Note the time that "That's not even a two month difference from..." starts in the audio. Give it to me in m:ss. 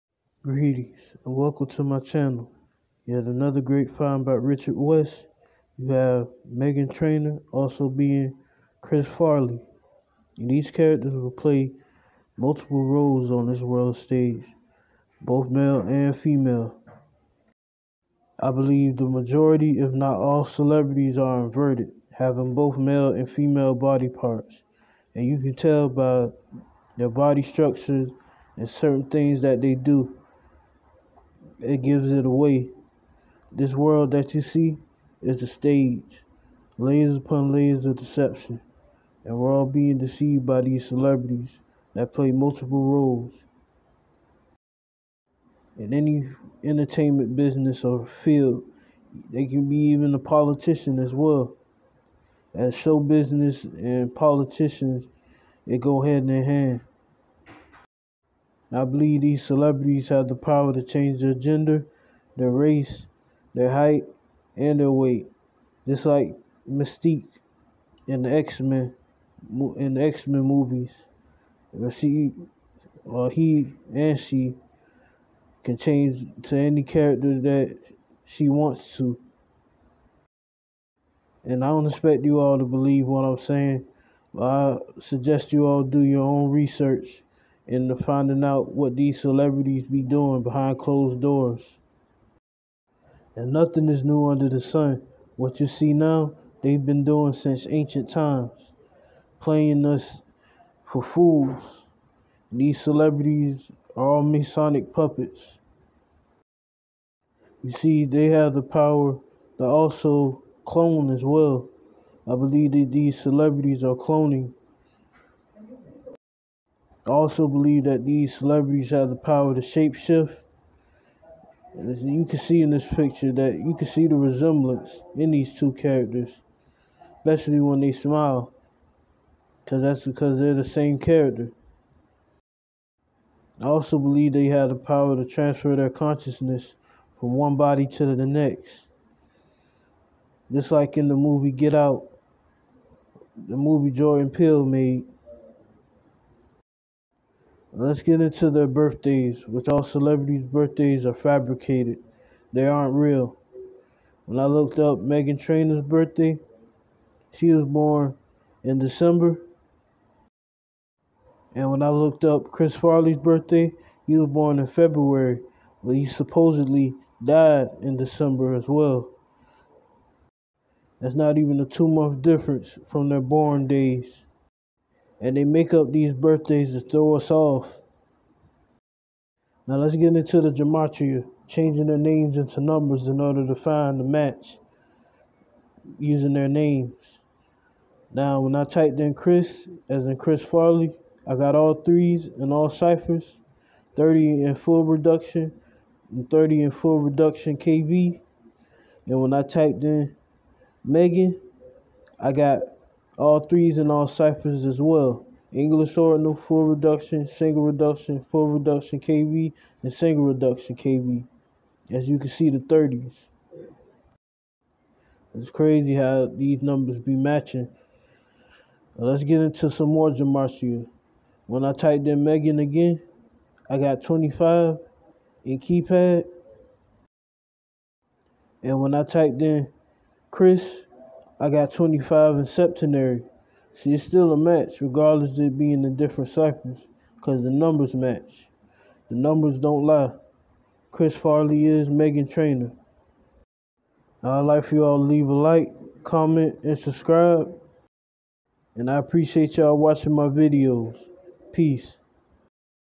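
2:50.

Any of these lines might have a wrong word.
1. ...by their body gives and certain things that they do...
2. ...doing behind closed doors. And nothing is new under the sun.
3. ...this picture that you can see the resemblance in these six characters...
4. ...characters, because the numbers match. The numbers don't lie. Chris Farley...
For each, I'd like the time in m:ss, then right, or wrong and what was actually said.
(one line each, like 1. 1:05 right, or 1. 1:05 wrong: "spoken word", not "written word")
1. 0:25 wrong: "structures", not "gives"
2. 1:30 right
3. 2:02 wrong: "two", not "six"
4. 3:56 wrong: "ciphers", not "characters".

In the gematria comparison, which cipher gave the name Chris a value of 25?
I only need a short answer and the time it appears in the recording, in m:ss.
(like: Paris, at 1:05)
septenary, at 3:52.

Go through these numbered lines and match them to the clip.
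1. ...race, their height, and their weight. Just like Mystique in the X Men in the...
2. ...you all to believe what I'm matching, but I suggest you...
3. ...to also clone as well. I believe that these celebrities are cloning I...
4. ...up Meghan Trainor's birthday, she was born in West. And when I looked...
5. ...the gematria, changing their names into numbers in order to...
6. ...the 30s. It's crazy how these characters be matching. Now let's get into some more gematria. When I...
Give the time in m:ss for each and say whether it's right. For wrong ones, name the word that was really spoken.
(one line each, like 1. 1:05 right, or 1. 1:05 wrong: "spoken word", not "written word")
1. 1:02 right
2. 1:22 wrong: "saying", not "matching"
3. 1:49 right
4. 2:34 wrong: "December", not "West"
5. 3:00 right
6. 3:32 wrong: "numbers", not "characters".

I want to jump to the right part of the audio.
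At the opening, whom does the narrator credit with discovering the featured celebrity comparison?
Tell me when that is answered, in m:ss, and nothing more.
0:04.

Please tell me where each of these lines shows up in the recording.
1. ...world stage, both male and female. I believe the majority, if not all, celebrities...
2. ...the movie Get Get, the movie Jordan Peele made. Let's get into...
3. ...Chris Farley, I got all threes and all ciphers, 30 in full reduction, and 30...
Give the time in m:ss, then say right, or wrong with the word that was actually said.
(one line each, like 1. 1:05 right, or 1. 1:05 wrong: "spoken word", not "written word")
1. 0:13 right
2. 2:21 wrong: "Out", not "Get"
3. 3:10 right.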